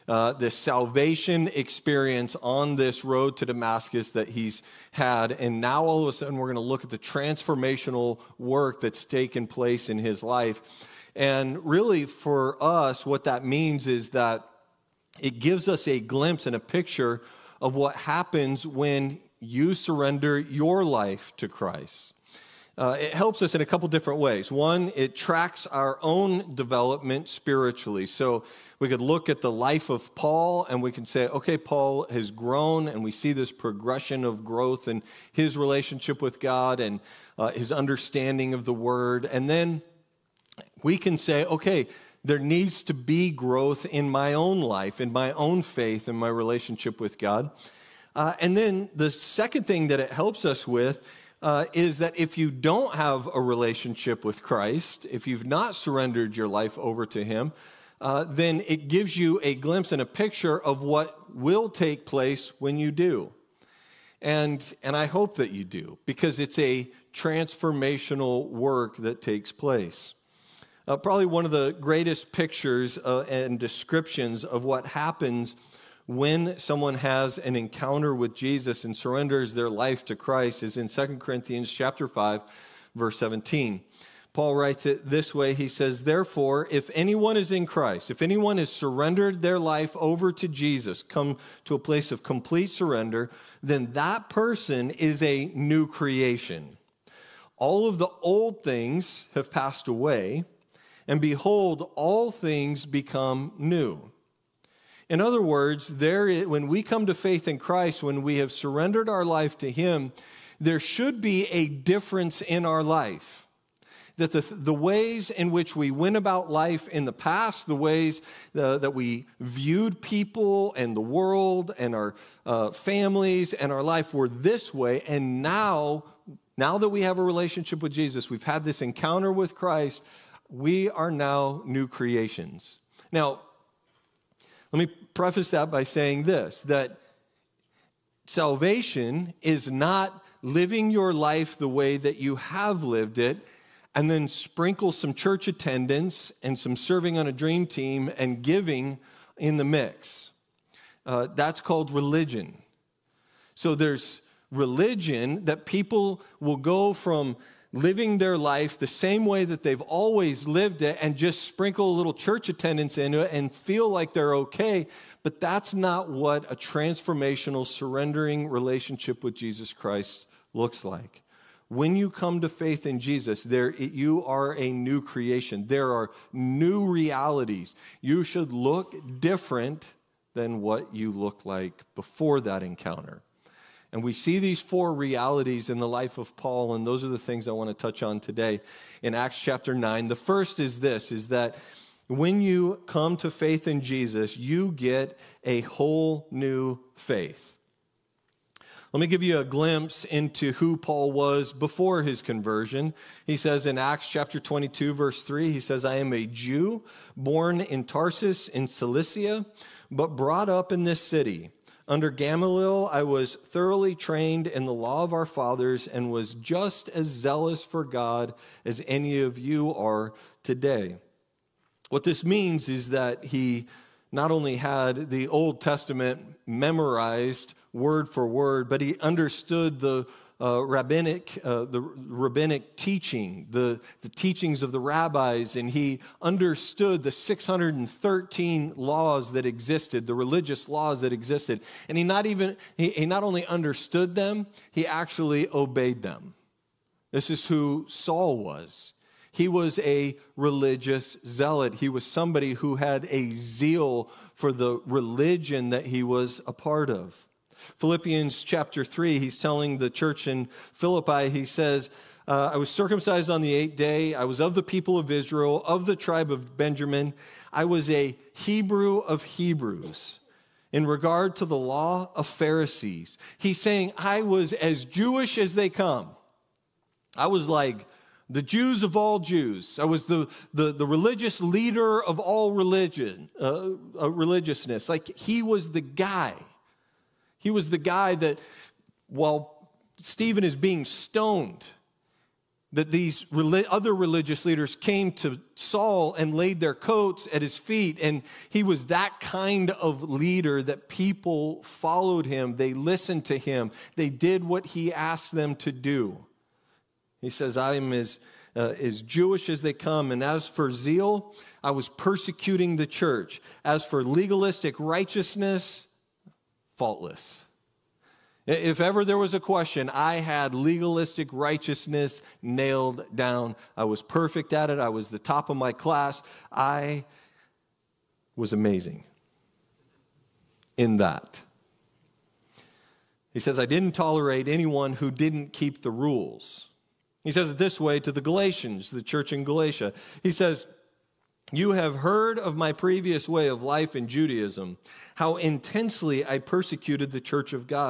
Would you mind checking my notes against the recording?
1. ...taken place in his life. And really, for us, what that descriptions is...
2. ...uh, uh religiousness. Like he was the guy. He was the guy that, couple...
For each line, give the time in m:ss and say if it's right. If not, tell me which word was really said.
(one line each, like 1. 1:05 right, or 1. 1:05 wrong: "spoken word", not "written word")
1. 0:09 wrong: "means", not "descriptions"
2. 4:43 wrong: "while", not "couple".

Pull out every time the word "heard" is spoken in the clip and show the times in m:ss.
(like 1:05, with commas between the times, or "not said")
5:41.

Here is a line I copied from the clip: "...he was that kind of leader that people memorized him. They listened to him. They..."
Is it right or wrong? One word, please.
wrong.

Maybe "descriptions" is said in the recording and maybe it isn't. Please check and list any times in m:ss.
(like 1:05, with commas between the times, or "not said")
1:13.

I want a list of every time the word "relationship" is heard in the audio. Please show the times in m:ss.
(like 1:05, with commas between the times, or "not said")
0:35, 0:46, 0:53, 2:07, 2:48.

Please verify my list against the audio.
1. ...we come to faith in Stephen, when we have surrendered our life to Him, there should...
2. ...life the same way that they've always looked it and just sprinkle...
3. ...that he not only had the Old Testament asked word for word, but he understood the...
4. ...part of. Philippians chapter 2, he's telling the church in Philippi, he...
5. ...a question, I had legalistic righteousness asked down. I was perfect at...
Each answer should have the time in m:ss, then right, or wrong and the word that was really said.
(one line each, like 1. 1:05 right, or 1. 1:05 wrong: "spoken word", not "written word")
1. 1:46 wrong: "Christ", not "Stephen"
2. 2:38 wrong: "lived", not "looked"
3. 3:42 wrong: "memorized", not "asked"
4. 4:16 wrong: "3", not "2"
5. 5:19 wrong: "nailed", not "asked".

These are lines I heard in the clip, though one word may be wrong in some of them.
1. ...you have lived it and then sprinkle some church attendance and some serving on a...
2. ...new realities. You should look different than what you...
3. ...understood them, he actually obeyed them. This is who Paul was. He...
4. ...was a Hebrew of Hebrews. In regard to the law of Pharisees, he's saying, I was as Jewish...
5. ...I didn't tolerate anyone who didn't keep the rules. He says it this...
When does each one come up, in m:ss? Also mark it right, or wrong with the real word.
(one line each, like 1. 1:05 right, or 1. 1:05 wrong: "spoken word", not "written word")
1. 2:22 right
2. 2:56 right
3. 4:03 wrong: "Saul", not "Paul"
4. 4:27 right
5. 5:33 right.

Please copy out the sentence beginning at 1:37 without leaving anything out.
All of the old things have passed away." and behold, all things become new.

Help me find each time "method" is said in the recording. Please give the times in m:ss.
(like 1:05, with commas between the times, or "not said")
not said.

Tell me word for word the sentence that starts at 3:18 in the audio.
Let me give you a glimpse into who Paul was before his conversion.